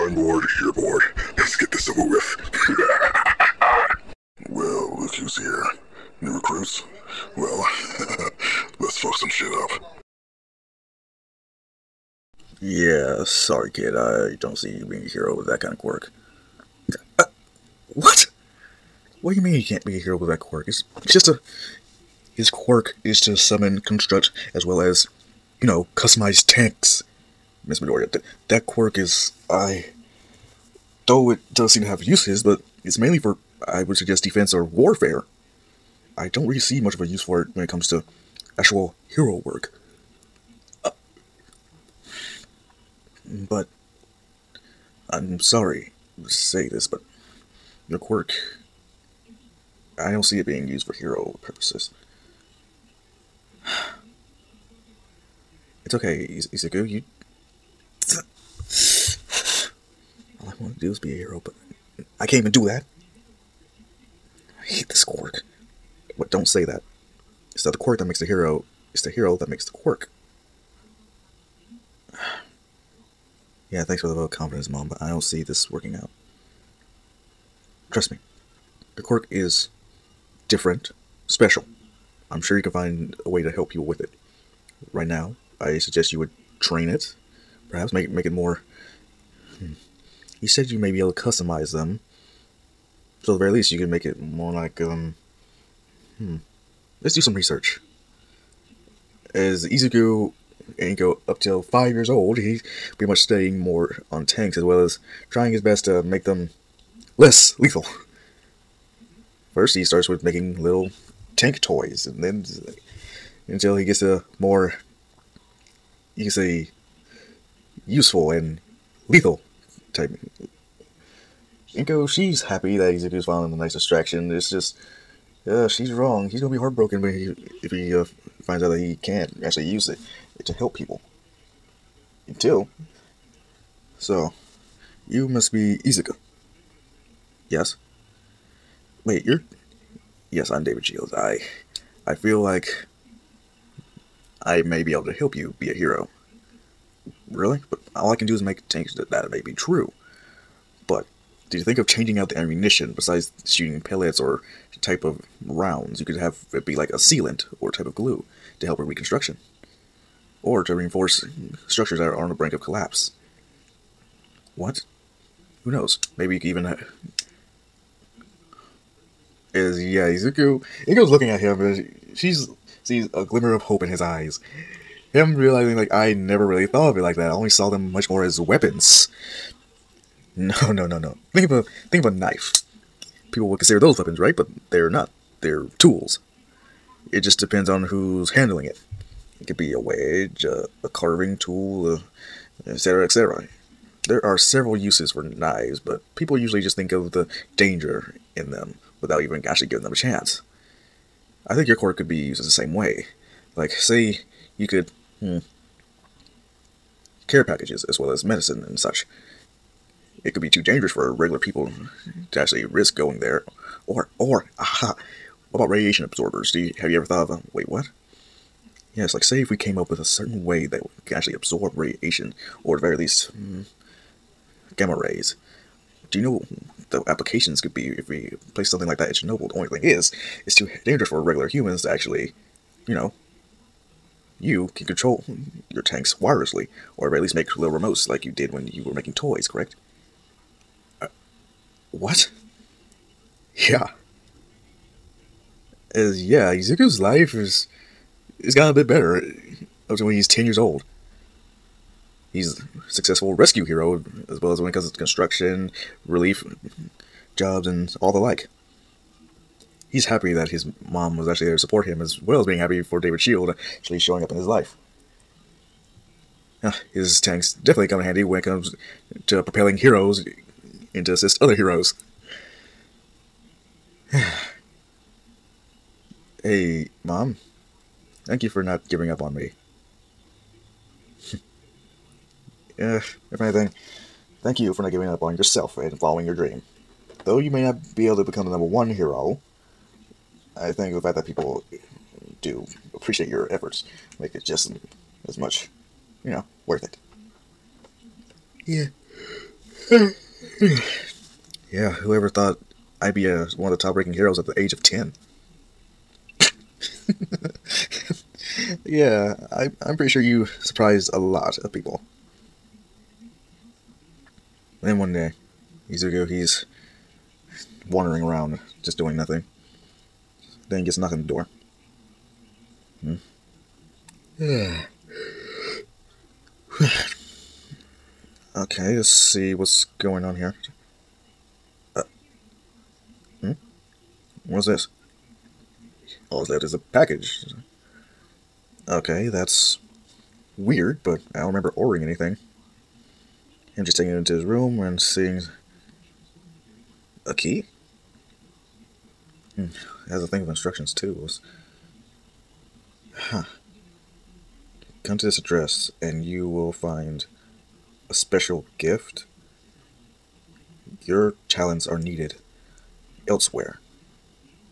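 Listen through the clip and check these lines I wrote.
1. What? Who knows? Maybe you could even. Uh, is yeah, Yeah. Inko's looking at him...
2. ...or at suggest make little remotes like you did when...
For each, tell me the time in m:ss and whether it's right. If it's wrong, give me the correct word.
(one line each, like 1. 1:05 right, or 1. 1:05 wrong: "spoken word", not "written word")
1. 2:44 wrong: "Izuku", not "Yeah"
2. 3:56 wrong: "least", not "suggest".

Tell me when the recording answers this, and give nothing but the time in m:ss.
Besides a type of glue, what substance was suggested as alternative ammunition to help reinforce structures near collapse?
2:36.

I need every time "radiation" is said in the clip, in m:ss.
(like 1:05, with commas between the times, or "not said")
3:35, 3:41.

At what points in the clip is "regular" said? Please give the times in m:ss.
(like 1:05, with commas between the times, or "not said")
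3:31, 3:51.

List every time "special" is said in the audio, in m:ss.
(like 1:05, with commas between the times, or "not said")
1:21, 5:58.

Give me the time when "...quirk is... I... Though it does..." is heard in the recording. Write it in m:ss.
0:28.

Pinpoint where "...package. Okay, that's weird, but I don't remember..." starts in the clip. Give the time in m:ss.
5:36.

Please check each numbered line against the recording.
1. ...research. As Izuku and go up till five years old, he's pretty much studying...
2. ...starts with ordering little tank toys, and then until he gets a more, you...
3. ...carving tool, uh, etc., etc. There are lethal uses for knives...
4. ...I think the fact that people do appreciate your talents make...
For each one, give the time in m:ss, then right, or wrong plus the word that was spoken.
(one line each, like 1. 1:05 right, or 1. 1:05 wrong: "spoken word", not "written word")
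1. 1:37 right
2. 1:49 wrong: "making", not "ordering"
3. 3:10 wrong: "several", not "lethal"
4. 4:50 wrong: "efforts", not "talents".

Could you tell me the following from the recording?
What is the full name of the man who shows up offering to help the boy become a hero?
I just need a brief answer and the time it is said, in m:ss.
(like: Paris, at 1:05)
David Shields, at 2:20.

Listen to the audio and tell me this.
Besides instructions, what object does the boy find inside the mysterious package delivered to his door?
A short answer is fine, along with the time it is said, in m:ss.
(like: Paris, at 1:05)
A key, at 5:47.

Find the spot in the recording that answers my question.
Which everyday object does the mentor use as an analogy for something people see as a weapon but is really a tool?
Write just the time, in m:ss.
3:02.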